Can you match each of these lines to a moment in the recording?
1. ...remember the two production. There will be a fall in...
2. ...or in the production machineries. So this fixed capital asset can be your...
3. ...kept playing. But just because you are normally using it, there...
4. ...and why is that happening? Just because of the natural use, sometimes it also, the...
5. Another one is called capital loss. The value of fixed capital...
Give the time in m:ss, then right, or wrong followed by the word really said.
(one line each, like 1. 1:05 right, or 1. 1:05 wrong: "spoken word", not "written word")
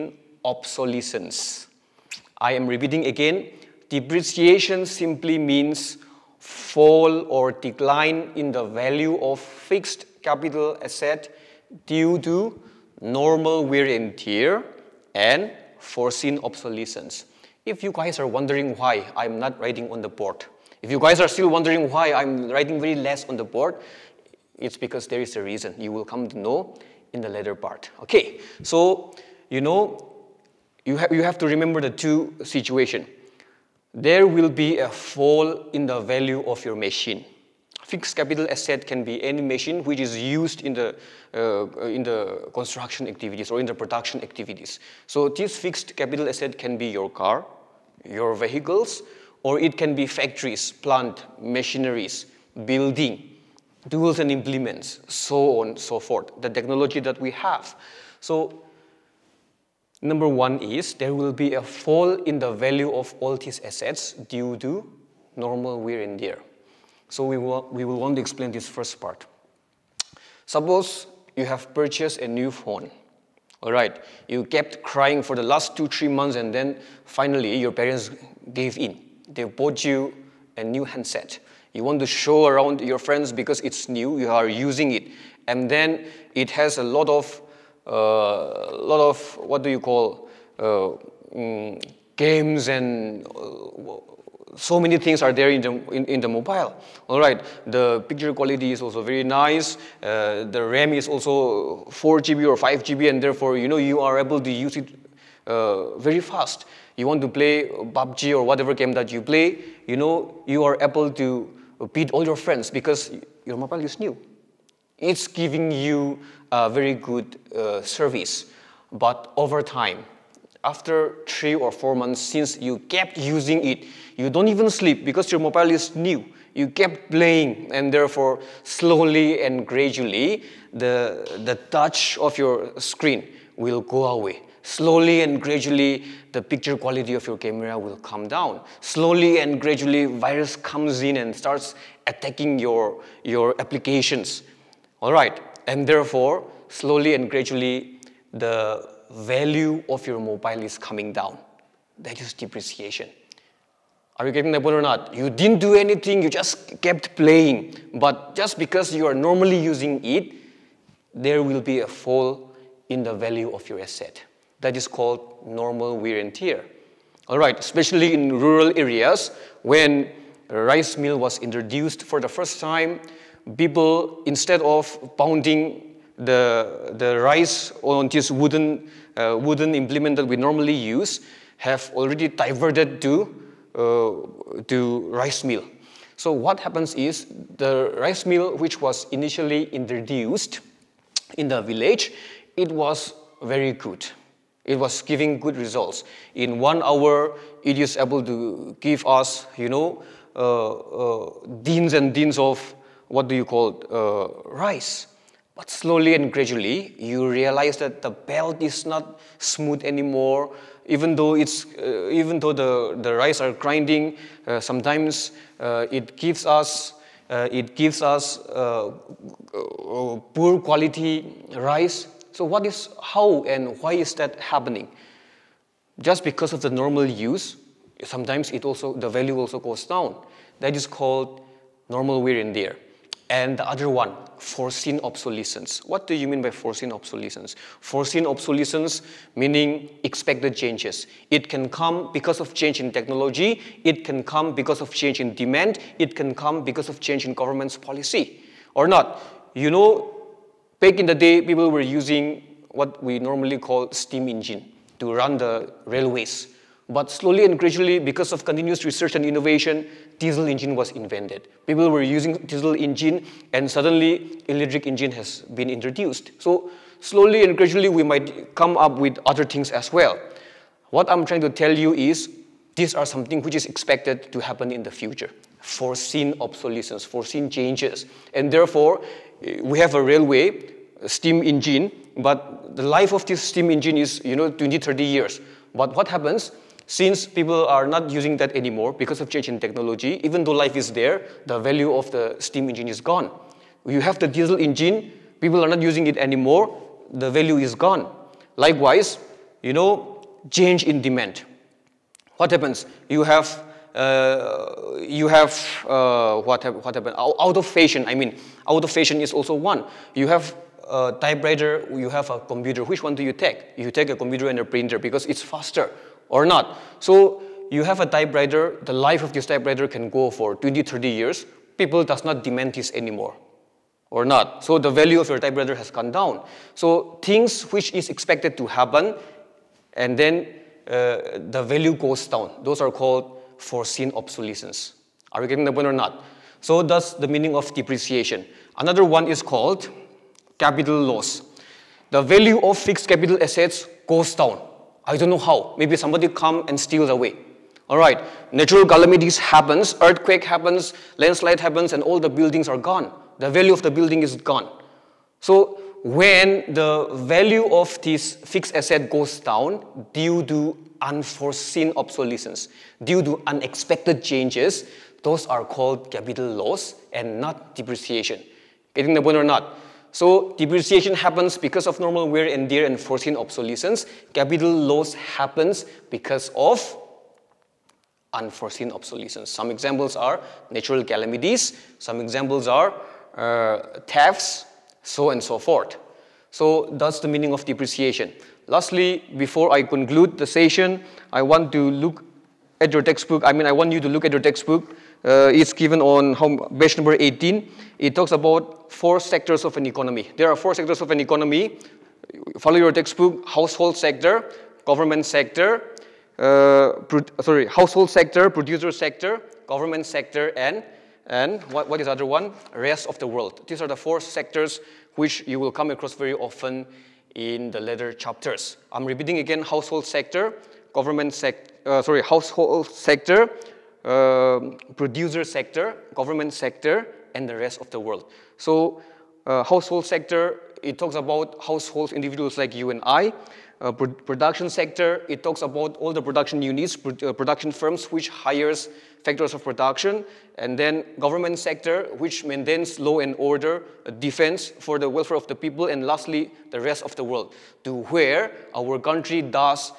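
1. 0:31 wrong: "situation", not "production"
2. 0:43 wrong: "activities", not "machineries"
3. 2:36 right
4. 3:43 wrong: "normal", not "natural"
5. 5:38 right.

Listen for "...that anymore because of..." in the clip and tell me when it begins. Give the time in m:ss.
4:48.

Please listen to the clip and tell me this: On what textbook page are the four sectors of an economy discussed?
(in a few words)
18.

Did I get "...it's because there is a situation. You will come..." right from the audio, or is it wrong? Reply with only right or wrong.
wrong.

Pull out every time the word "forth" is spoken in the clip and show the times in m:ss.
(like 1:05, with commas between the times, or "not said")
0:55, 6:25.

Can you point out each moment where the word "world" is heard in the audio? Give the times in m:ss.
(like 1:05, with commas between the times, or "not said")
6:53, 7:07, 7:27.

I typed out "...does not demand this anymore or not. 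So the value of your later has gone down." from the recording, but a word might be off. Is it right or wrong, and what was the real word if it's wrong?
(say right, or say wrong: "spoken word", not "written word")
wrong: "typewriter", not "later".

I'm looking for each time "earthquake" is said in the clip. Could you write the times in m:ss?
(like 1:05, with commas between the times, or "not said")
5:49.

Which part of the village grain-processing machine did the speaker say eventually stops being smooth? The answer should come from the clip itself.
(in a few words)
the belt.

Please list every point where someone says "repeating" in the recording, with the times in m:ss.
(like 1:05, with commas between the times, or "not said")
0:02, 6:59.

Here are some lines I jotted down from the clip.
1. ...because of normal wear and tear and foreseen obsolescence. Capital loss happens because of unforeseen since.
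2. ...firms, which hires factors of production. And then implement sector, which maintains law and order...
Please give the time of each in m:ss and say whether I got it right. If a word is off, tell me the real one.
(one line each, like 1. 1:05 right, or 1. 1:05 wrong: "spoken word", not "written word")
1. 6:11 wrong: "obsolescence", not "since"
2. 7:17 wrong: "government", not "implement".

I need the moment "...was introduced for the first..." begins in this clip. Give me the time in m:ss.
2:51.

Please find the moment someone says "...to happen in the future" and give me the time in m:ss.
4:34.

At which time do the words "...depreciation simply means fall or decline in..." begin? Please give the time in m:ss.
0:03.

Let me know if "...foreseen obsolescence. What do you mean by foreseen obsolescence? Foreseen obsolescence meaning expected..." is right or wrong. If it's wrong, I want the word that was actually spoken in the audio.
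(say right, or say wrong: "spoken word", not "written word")
right.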